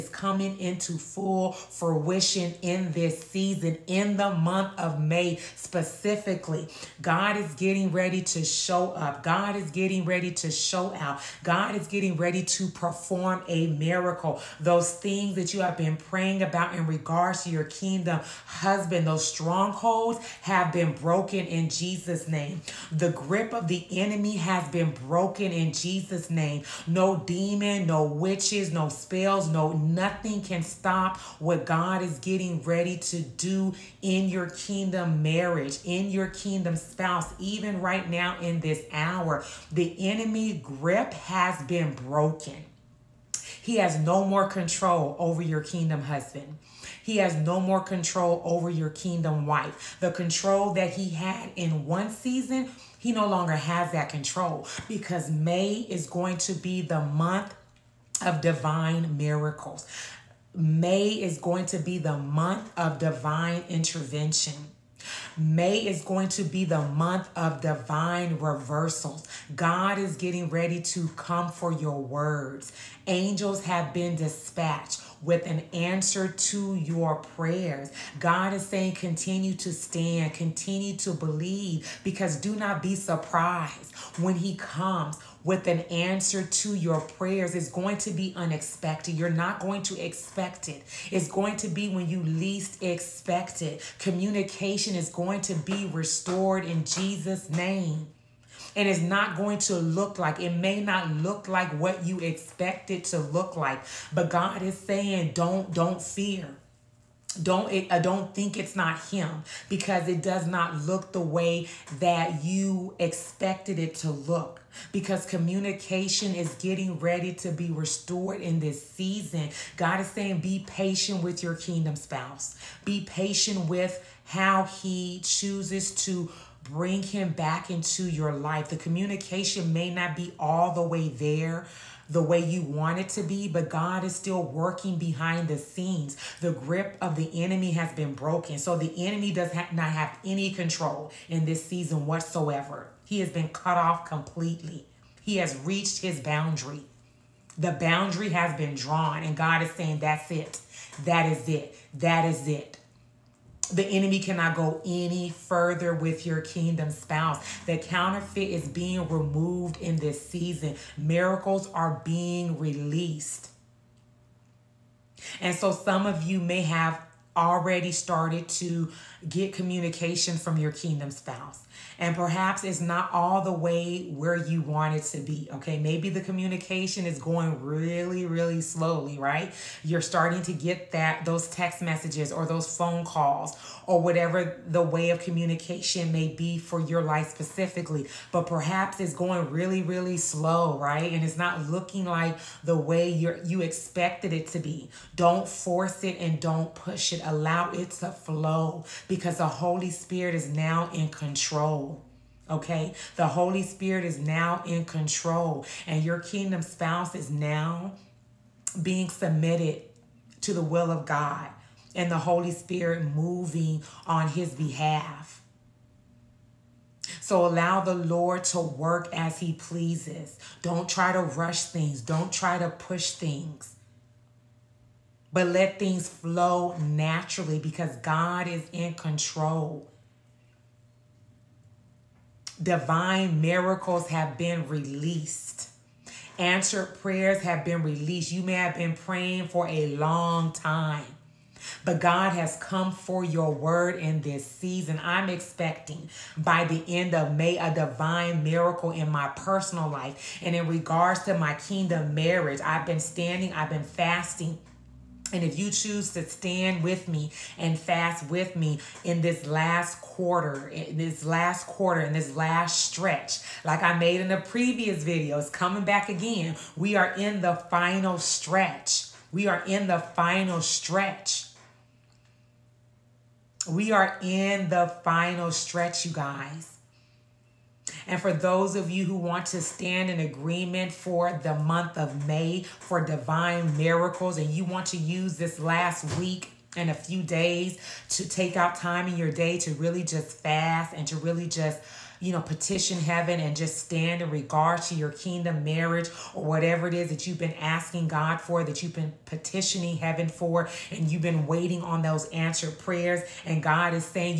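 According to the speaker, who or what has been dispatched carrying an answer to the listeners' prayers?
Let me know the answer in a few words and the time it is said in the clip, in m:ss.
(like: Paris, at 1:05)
Angels, at 1:13.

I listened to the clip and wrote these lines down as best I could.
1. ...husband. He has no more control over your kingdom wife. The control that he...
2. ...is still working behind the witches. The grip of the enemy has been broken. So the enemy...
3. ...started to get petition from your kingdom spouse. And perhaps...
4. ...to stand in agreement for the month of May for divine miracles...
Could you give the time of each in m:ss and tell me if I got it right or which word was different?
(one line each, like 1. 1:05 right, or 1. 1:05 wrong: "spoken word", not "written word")
1. 0:46 right
2. 2:14 wrong: "scenes", not "witches"
3. 2:47 wrong: "communication", not "petition"
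4. 4:39 right.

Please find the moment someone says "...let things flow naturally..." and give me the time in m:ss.
3:45.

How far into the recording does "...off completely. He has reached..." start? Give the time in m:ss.
2:23.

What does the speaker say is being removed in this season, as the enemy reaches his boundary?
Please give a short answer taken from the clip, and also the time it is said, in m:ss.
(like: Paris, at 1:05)
The counterfeit, at 2:37.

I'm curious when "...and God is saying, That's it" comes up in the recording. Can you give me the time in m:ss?
2:29.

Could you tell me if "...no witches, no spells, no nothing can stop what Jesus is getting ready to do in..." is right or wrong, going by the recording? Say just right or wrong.
wrong.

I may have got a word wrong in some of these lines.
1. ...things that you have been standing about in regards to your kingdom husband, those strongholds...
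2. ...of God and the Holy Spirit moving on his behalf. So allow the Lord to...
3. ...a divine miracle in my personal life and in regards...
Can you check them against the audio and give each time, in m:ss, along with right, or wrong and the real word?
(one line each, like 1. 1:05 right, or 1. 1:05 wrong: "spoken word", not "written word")
1. 0:14 wrong: "praying", not "standing"
2. 3:30 right
3. 4:07 right.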